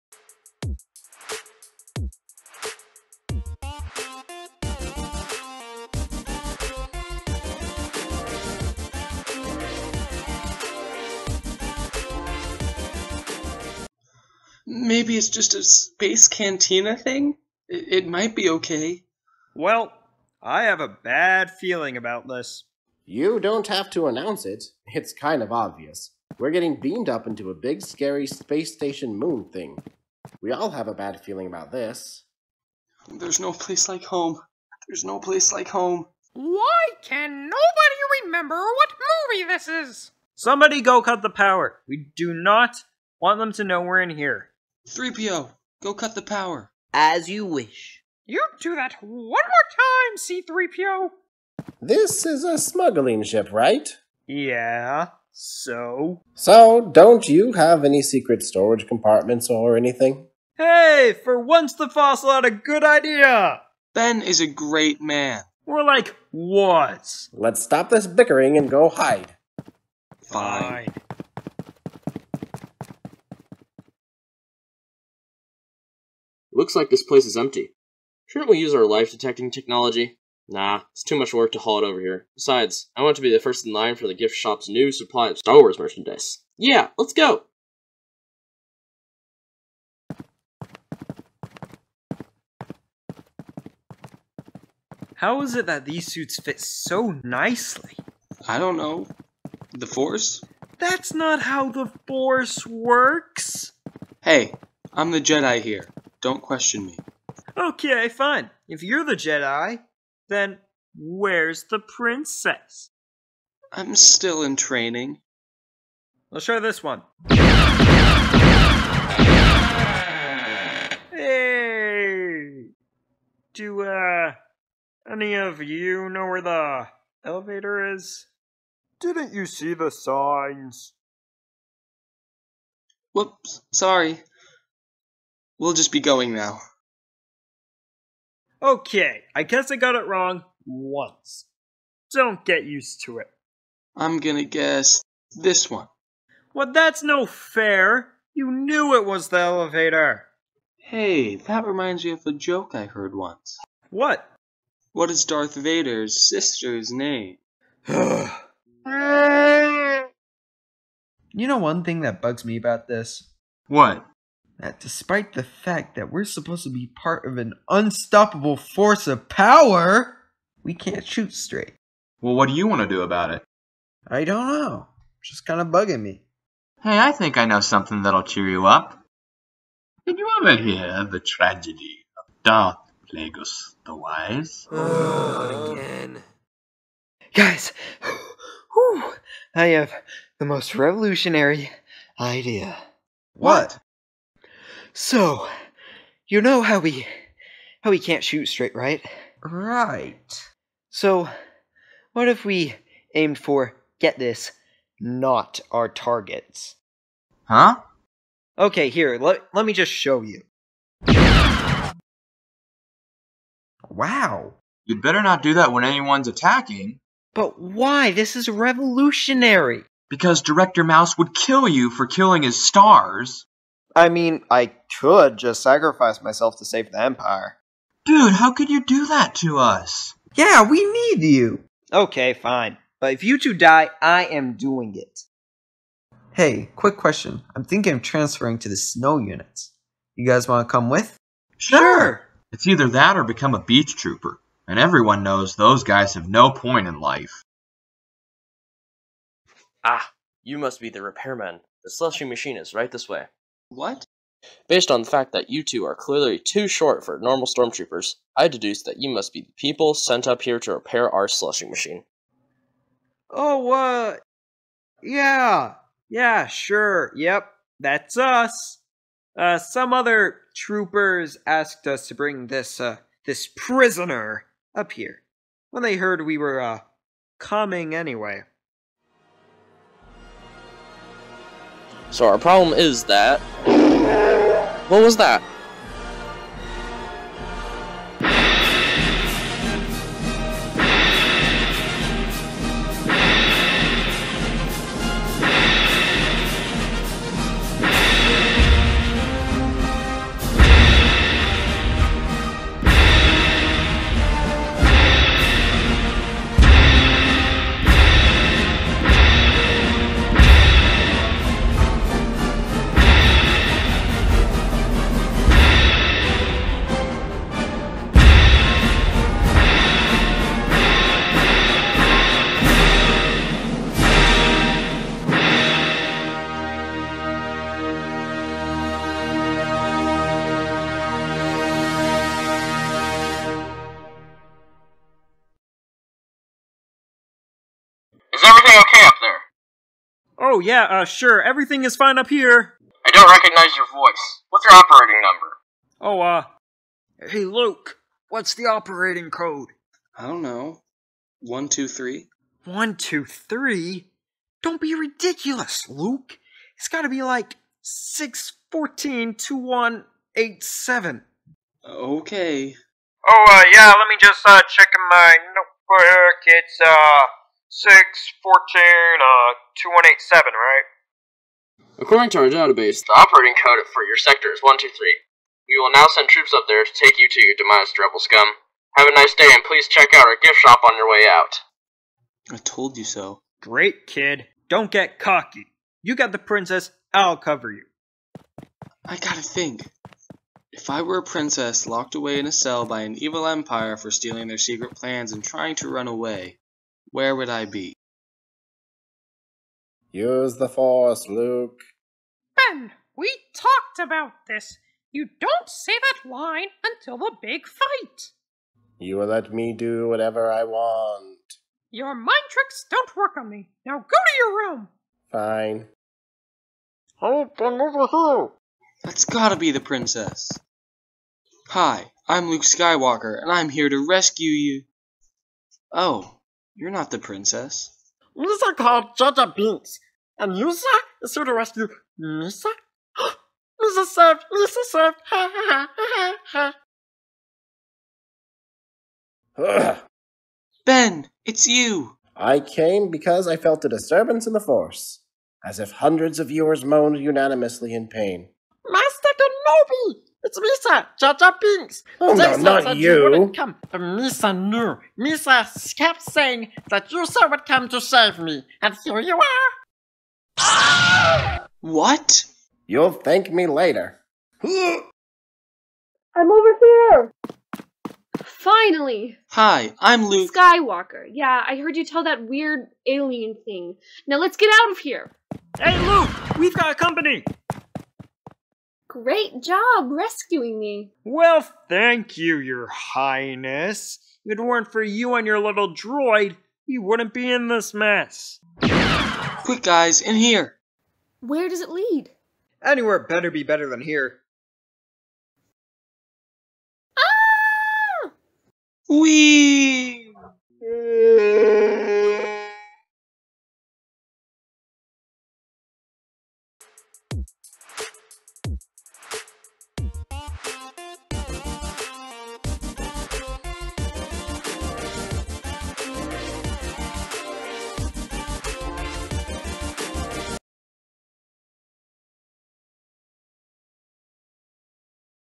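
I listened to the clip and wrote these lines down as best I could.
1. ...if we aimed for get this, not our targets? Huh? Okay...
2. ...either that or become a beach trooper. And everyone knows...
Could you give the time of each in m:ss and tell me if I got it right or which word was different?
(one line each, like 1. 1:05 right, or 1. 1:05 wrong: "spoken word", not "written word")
1. 3:22 right
2. 4:02 right.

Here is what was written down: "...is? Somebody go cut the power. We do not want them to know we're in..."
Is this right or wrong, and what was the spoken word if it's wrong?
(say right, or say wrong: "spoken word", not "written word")
right.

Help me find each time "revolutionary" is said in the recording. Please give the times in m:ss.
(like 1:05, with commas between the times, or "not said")
3:10, 3:38.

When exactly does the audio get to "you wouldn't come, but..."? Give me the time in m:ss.
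7:33.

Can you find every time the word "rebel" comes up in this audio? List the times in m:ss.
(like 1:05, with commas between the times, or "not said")
6:17.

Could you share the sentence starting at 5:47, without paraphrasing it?
Hey, Luke, what's the operating code?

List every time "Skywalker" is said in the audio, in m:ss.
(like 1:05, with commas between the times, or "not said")
7:02, 7:50.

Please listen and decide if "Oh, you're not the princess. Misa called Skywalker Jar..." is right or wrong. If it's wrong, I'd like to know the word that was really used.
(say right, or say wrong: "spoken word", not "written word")
wrong: "Jar", not "Skywalker".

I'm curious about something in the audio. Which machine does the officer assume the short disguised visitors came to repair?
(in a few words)
The slushy machine.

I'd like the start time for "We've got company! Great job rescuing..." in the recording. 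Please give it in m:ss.
7:56.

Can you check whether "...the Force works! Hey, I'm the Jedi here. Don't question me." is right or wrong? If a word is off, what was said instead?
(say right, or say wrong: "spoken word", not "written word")
right.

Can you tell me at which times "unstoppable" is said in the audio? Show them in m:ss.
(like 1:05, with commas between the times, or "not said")
2:47.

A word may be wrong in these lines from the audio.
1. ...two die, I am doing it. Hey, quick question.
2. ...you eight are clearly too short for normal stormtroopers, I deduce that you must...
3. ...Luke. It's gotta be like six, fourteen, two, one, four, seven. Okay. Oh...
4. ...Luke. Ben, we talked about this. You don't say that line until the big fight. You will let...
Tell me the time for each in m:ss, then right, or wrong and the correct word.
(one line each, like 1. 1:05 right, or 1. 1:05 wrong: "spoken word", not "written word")
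1. 3:53 right
2. 4:15 wrong: "two", not "eight"
3. 5:55 wrong: "eight", not "four"
4. 6:41 right.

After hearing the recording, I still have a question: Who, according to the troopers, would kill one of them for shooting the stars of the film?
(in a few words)
Director Mouse.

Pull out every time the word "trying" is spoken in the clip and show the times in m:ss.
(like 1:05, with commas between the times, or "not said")
6:35.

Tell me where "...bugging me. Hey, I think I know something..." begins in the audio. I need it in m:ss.
2:55.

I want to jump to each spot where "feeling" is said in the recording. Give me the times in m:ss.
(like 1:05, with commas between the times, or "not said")
0:21, 0:31.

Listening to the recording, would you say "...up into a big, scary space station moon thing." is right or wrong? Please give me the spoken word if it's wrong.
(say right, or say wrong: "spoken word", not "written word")
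right.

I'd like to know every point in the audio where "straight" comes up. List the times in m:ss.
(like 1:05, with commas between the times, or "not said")
2:51, 3:18.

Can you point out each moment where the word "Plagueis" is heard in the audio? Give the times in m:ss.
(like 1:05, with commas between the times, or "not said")
3:03.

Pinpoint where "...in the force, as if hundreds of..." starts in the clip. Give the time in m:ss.
7:24.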